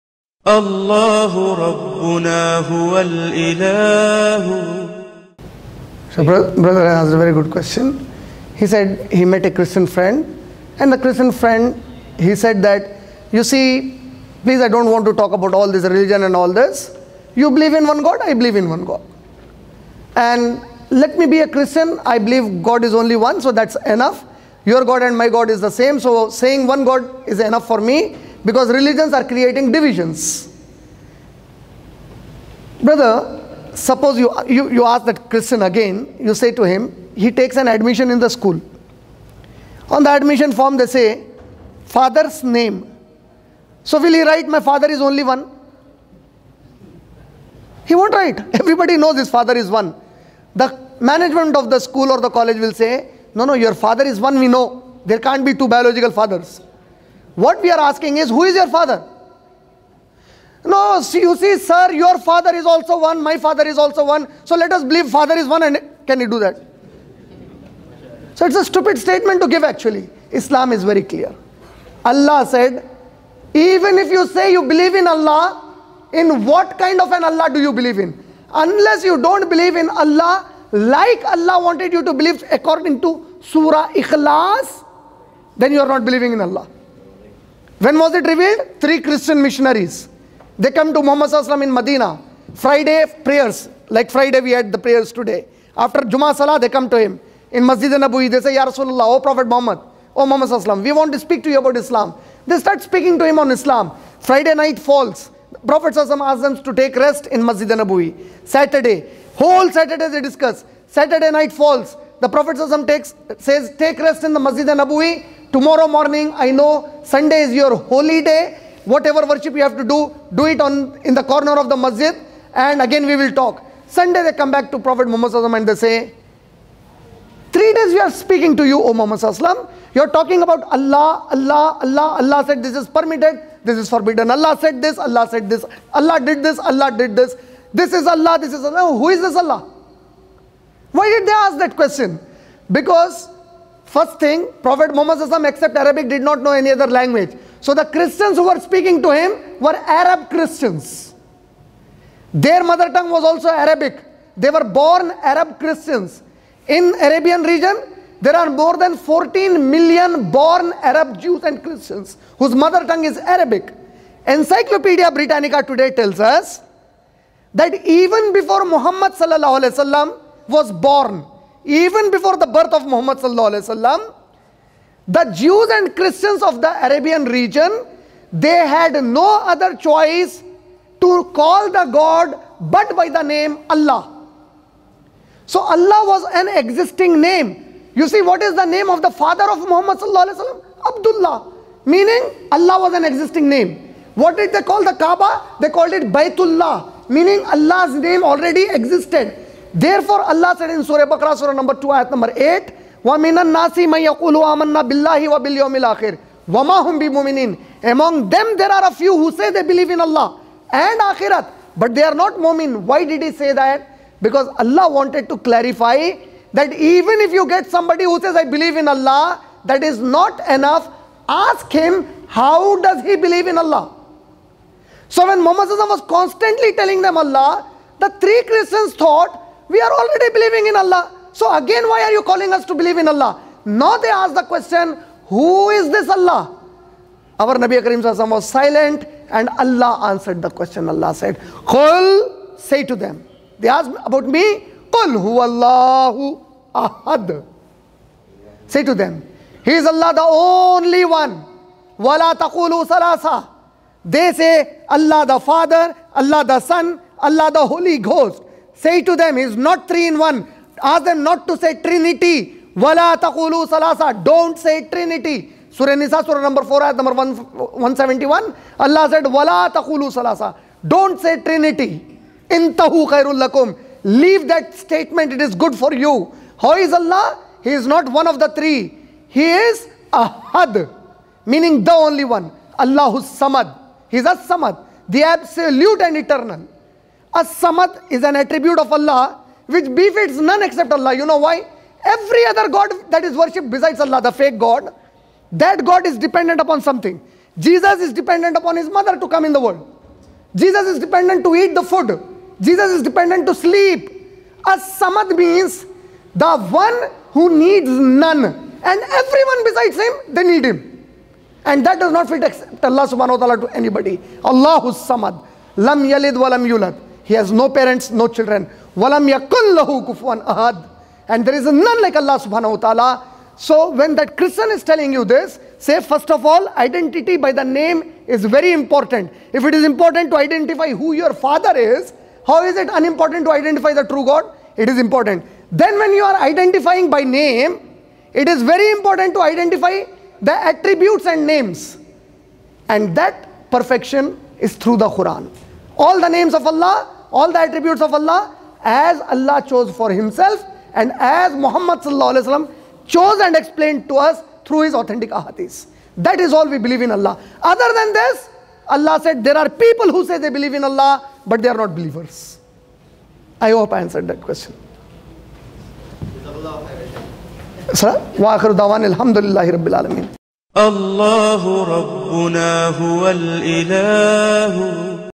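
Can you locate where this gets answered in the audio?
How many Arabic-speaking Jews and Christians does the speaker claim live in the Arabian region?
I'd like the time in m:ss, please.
2:38.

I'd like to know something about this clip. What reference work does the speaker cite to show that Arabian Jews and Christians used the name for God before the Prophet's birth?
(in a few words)
Encyclopedia Britannica.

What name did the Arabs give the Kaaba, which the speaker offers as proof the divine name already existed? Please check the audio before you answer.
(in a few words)
Baytullah.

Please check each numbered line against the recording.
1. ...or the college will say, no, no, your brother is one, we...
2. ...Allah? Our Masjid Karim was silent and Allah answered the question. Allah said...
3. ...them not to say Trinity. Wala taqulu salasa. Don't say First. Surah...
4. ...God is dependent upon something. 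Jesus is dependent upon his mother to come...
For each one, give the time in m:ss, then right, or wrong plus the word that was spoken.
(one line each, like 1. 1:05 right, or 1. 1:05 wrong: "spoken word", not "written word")
1. 0:52 wrong: "father", not "brother"
2. 3:56 wrong: "Nabi", not "Masjid"
3. 4:21 wrong: "Trinity", not "First"
4. 4:55 right.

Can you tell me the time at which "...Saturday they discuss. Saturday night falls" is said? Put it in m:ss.
1:49.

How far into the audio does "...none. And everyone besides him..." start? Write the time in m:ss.
5:07.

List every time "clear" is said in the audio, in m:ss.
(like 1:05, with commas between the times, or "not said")
1:11.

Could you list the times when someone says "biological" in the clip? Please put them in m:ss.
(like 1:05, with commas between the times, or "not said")
0:55.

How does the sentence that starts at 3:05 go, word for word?
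So Allah was an existing name.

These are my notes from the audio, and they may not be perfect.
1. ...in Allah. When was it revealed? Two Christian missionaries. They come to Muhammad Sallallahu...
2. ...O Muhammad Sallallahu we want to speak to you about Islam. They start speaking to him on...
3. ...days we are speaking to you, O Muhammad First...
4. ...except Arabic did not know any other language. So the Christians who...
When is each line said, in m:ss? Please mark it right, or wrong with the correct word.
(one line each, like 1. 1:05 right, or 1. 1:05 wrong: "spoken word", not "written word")
1. 1:26 wrong: "Three", not "Two"
2. 1:40 right
3. 2:07 wrong: "You", not "First"
4. 2:25 right.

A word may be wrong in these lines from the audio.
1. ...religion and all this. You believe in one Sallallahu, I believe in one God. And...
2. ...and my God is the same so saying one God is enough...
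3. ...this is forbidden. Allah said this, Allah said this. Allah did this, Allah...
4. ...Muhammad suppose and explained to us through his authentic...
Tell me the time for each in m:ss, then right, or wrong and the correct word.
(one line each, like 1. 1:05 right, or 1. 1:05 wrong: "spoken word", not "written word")
1. 0:15 wrong: "God", not "Sallallahu"
2. 0:25 right
3. 2:13 right
4. 5:51 wrong: "chose", not "suppose".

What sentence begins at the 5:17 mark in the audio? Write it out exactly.
He has no parents, no children.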